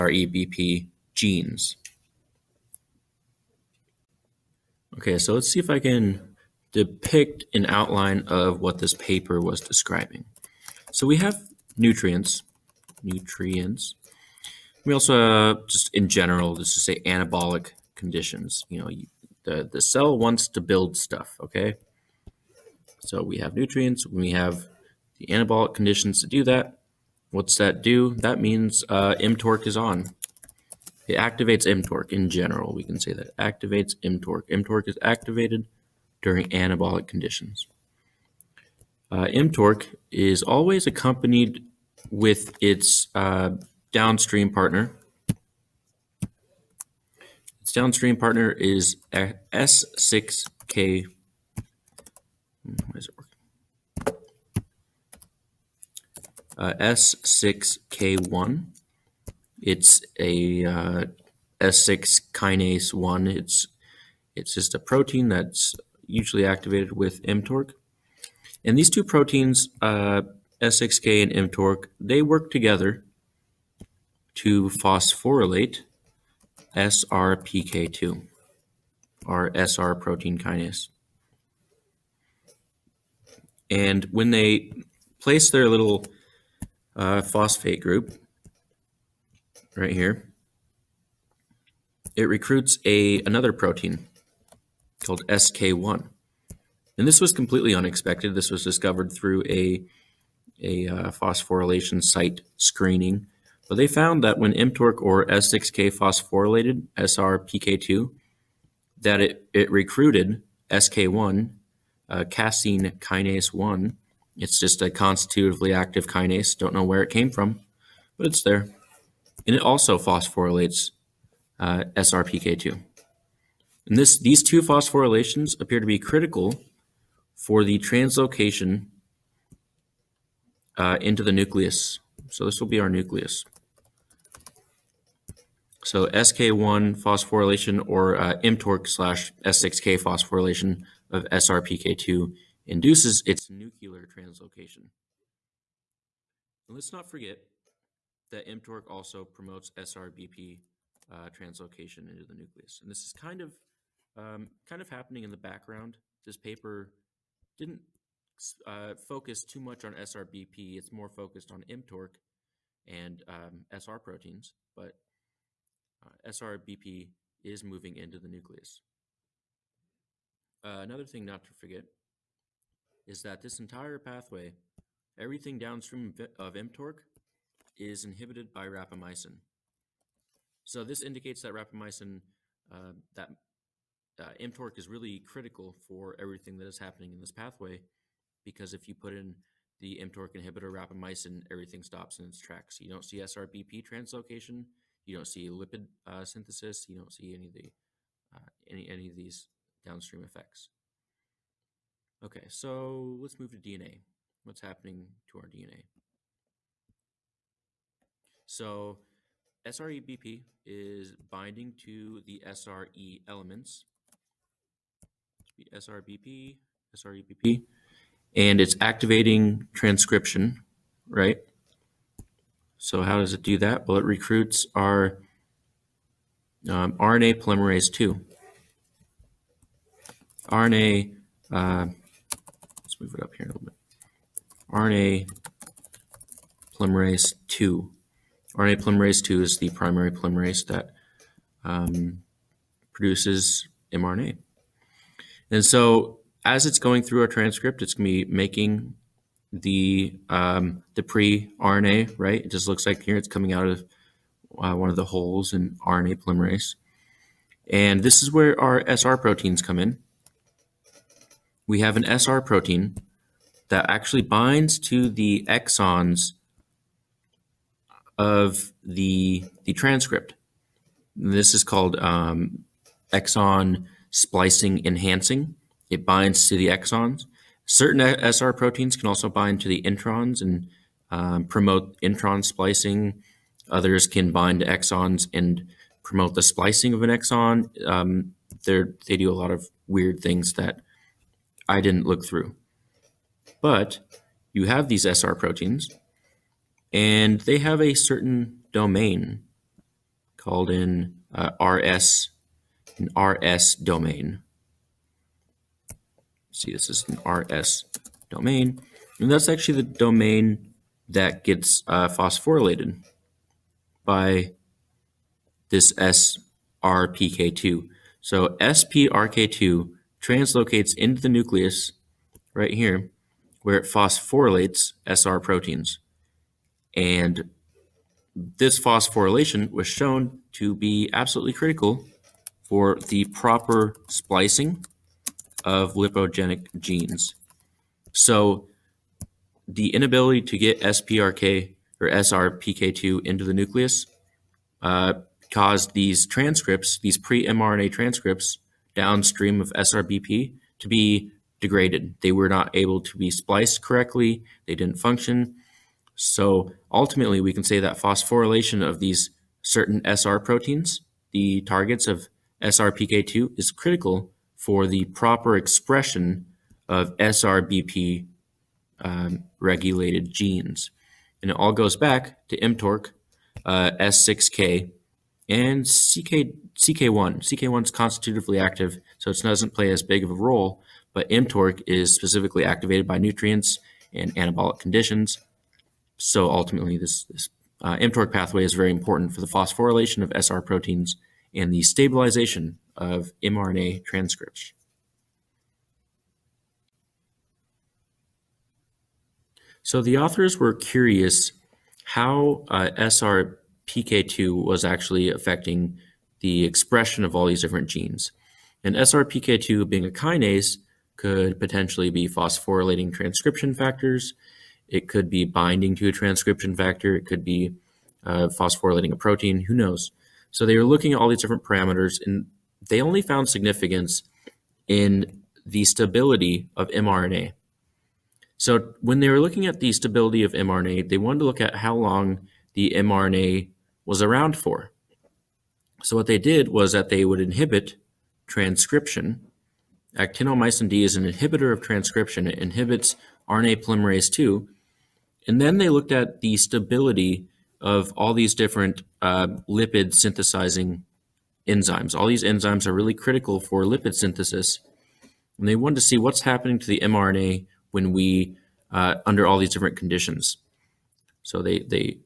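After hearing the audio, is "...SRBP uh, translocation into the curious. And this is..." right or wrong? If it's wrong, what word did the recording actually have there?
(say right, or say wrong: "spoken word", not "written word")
wrong: "nucleus", not "curious".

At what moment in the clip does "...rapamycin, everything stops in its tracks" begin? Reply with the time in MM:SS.
03:10.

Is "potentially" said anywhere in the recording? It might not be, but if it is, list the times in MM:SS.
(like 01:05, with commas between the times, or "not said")
06:51.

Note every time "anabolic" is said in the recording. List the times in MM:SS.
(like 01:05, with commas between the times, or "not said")
00:17, 00:25, 00:36, 06:24.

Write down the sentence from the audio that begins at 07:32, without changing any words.
All these enzymes are really critical for lipid synthesis.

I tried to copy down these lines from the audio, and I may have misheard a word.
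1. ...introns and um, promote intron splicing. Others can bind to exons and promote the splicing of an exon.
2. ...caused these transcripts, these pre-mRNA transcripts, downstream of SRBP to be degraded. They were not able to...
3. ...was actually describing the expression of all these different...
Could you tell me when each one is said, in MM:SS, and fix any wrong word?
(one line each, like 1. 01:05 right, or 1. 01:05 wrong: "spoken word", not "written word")
1. 04:39 right
2. 05:45 right
3. 06:44 wrong: "affecting", not "describing".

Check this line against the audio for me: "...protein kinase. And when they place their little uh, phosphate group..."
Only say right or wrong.
right.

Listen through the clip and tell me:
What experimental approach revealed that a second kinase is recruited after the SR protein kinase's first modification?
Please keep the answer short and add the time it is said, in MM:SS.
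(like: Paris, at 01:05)
phosphorylation site screening, at 01:41.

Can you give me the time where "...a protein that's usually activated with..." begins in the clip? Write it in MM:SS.
01:04.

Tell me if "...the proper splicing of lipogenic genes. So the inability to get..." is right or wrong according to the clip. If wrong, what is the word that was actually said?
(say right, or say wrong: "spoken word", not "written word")
right.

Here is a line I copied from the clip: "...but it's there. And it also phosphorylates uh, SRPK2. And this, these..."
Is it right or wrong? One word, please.
right.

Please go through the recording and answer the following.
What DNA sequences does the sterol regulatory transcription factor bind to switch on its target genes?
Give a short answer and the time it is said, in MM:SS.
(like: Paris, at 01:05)
SRE elements, at 03:32.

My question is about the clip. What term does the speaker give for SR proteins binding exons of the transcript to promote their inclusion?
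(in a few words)
exon splicing enhancing.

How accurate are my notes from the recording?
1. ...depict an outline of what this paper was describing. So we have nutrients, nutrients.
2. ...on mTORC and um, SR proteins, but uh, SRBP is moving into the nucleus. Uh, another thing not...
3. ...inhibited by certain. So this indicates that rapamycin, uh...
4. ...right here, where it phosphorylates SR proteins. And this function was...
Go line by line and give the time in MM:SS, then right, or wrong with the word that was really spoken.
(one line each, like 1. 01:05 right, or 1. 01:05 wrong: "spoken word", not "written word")
1. 00:06 right
2. 02:41 right
3. 02:58 wrong: "rapamycin", not "certain"
4. 05:22 wrong: "phosphorylation", not "function".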